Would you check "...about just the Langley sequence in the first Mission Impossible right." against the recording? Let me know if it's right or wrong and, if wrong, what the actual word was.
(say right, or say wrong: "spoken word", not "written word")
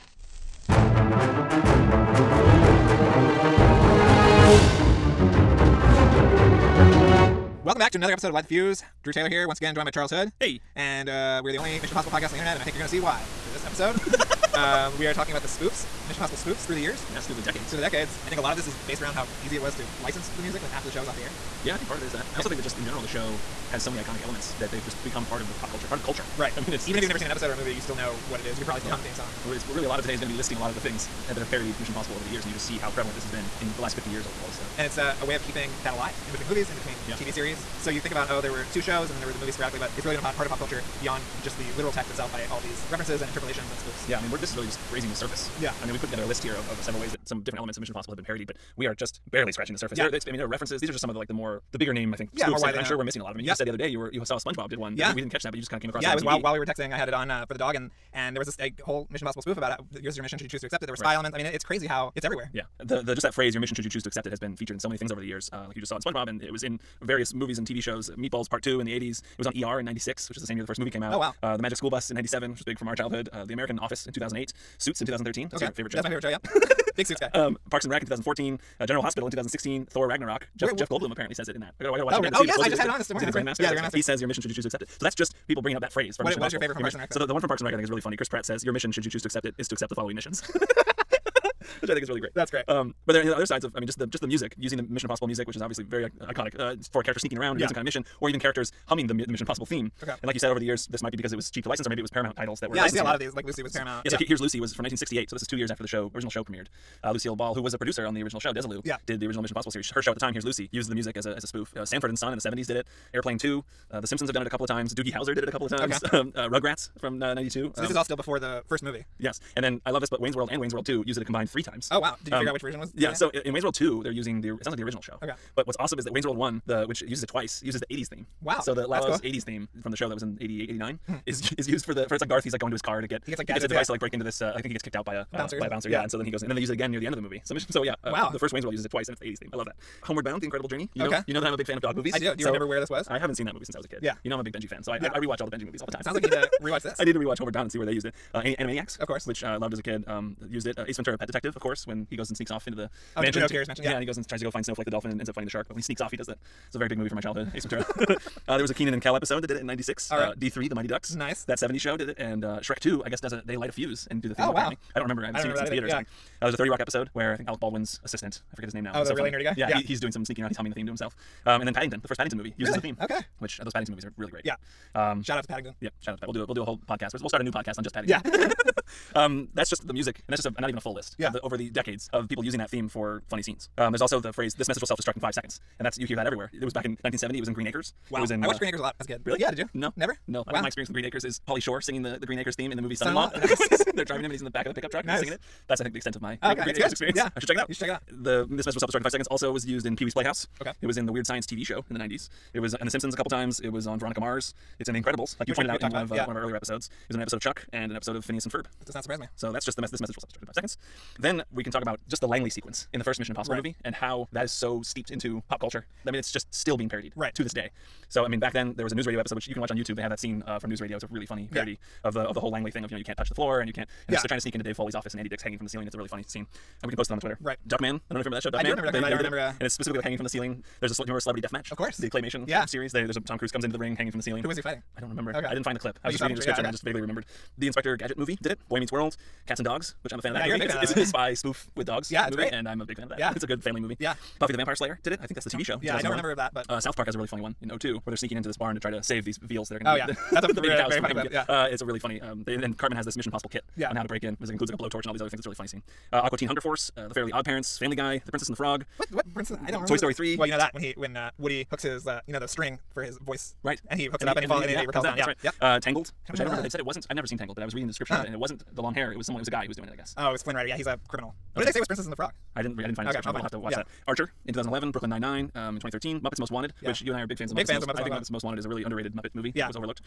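right.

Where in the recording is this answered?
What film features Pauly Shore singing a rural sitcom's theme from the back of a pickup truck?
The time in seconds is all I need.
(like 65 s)
192 s.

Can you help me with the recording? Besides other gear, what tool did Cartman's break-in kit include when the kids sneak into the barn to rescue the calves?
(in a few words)
a blowtorch.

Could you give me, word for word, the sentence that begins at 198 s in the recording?
The this message will self destruct in five seconds.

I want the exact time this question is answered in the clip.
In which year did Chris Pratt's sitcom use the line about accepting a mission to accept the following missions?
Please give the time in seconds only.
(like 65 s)
78 s.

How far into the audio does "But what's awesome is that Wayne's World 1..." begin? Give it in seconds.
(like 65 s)
125 s.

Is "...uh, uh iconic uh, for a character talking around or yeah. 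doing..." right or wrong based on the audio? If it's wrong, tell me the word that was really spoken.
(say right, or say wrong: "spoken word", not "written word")
wrong: "sneaking", not "talking".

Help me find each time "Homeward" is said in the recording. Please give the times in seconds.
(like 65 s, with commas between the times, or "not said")
140 s, 147 s.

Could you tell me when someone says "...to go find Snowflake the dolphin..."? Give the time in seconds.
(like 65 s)
154 s.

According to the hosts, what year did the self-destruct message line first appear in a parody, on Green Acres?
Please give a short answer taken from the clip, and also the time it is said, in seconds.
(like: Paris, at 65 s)
1970, at 187 s.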